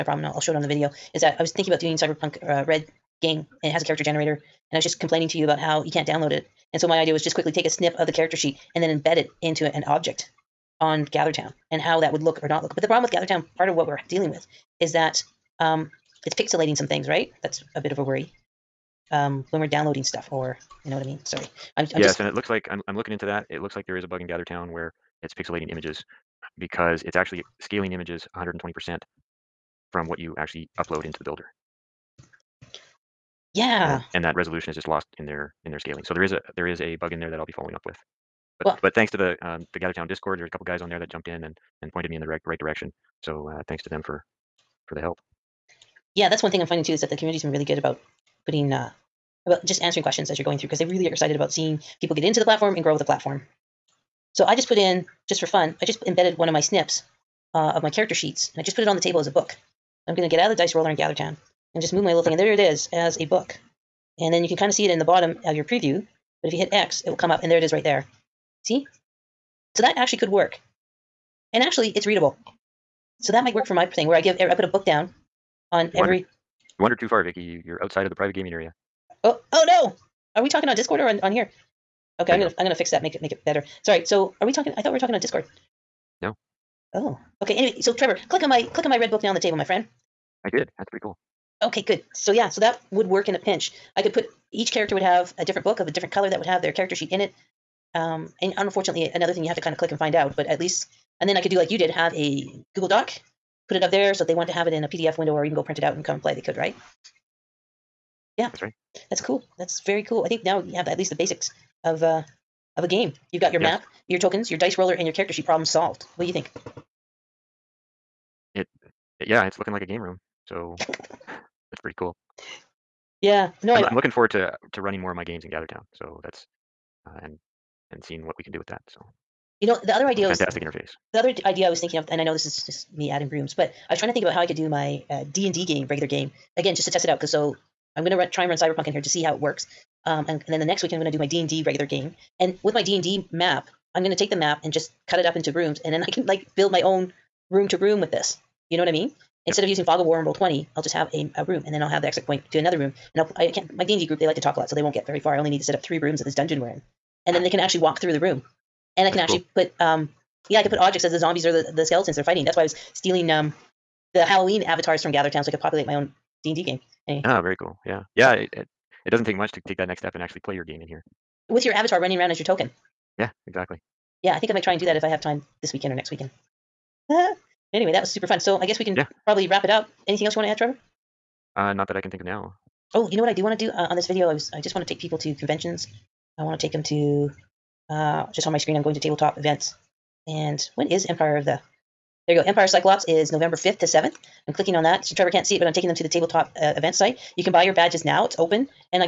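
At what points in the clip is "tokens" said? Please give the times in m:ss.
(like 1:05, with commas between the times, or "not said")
1:54, 2:52.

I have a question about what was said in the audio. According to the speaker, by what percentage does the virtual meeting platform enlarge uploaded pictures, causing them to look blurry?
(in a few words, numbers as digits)
120%.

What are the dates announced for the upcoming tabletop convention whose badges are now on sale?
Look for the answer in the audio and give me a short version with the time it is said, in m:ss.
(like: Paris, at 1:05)
November 5th to 7th, at 3:13.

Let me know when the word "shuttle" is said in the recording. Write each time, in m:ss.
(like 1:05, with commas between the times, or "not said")
not said.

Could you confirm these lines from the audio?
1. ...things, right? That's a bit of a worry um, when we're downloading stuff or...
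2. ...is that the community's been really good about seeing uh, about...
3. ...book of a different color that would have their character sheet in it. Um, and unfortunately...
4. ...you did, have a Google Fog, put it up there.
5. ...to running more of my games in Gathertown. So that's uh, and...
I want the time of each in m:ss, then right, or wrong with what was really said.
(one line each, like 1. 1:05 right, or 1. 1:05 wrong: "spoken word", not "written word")
1. 0:16 right
2. 0:46 wrong: "putting", not "seeing"
3. 1:35 right
4. 1:41 wrong: "Doc", not "Fog"
5. 2:04 right.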